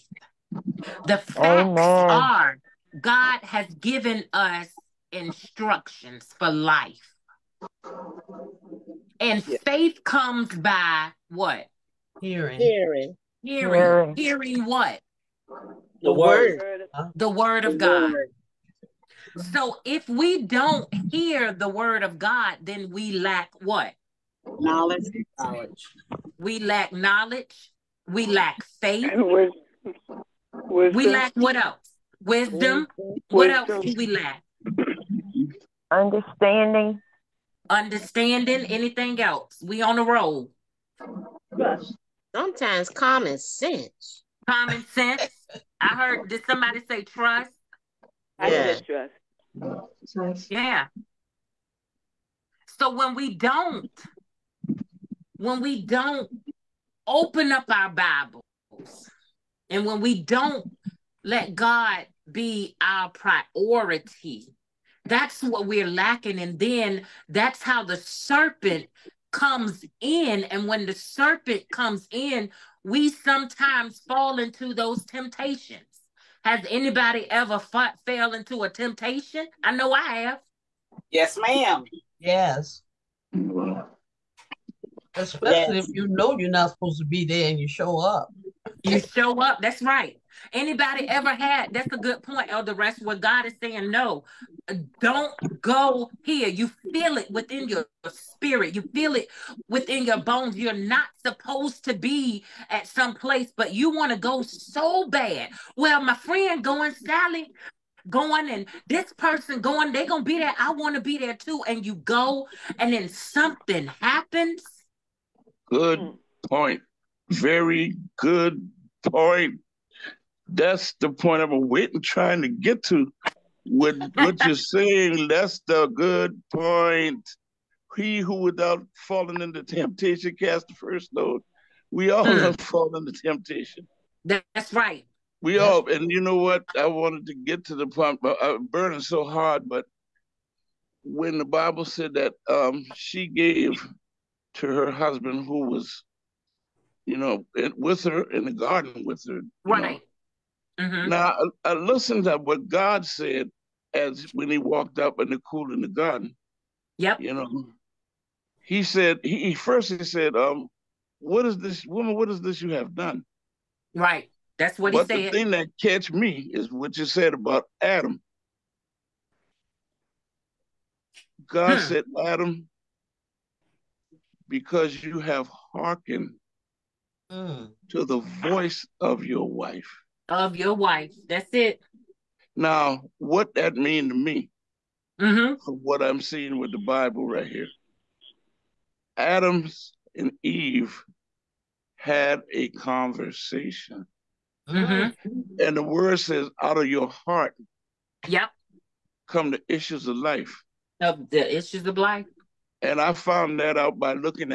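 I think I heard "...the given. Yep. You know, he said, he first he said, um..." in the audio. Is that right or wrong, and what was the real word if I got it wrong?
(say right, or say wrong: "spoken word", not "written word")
wrong: "garden", not "given".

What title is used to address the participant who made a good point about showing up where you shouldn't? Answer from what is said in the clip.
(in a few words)
Elder.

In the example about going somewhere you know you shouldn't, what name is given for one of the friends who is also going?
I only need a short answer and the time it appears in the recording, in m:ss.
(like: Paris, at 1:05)
Sally, at 1:46.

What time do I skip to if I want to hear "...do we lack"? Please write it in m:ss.
0:33.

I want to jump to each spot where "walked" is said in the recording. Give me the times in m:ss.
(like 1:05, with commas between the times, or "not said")
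2:34.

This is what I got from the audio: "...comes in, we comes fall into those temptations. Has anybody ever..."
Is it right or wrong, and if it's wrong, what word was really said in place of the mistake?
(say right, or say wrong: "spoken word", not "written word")
wrong: "sometimes", not "comes".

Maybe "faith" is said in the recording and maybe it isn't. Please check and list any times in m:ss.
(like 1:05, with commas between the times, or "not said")
0:09, 0:28.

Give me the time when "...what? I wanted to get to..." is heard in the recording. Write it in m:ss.
2:16.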